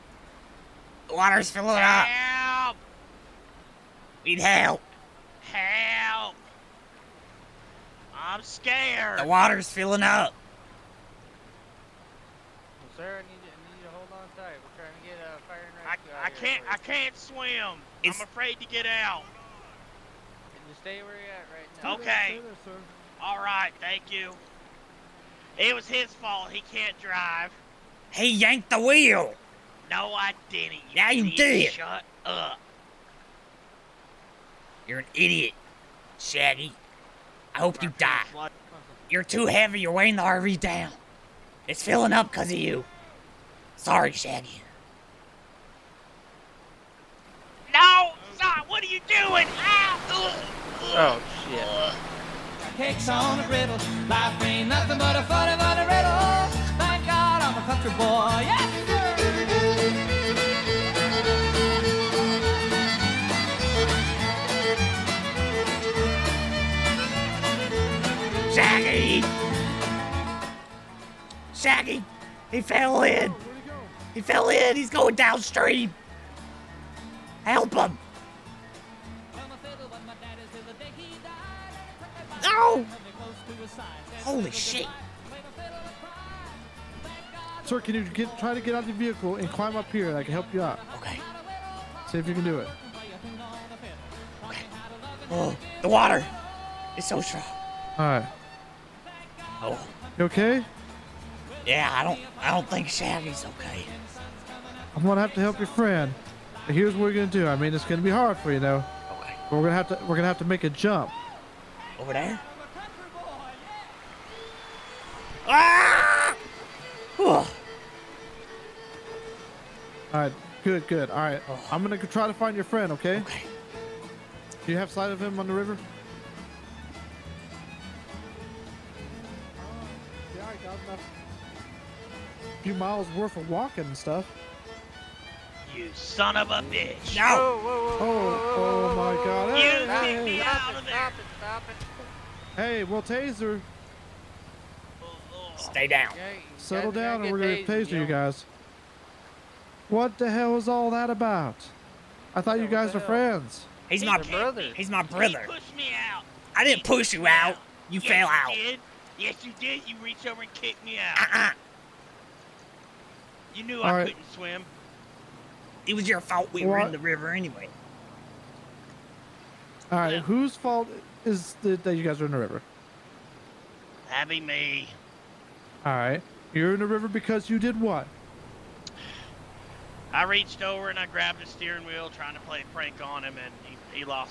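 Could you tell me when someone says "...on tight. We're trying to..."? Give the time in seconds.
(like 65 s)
14 s.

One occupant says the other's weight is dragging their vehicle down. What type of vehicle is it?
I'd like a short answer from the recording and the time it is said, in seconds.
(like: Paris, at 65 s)
RV, at 40 s.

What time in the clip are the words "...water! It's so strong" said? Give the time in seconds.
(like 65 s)
95 s.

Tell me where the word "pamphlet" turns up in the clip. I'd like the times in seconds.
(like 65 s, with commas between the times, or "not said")
not said.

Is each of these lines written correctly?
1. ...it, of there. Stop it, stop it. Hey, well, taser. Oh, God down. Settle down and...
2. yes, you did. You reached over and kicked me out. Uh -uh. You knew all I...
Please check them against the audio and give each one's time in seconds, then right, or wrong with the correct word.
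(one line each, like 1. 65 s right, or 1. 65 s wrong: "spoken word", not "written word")
1. 140 s wrong: "Stay", not "God"
2. 159 s right.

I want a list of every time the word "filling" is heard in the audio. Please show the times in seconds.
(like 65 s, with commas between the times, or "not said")
1 s, 9 s, 41 s.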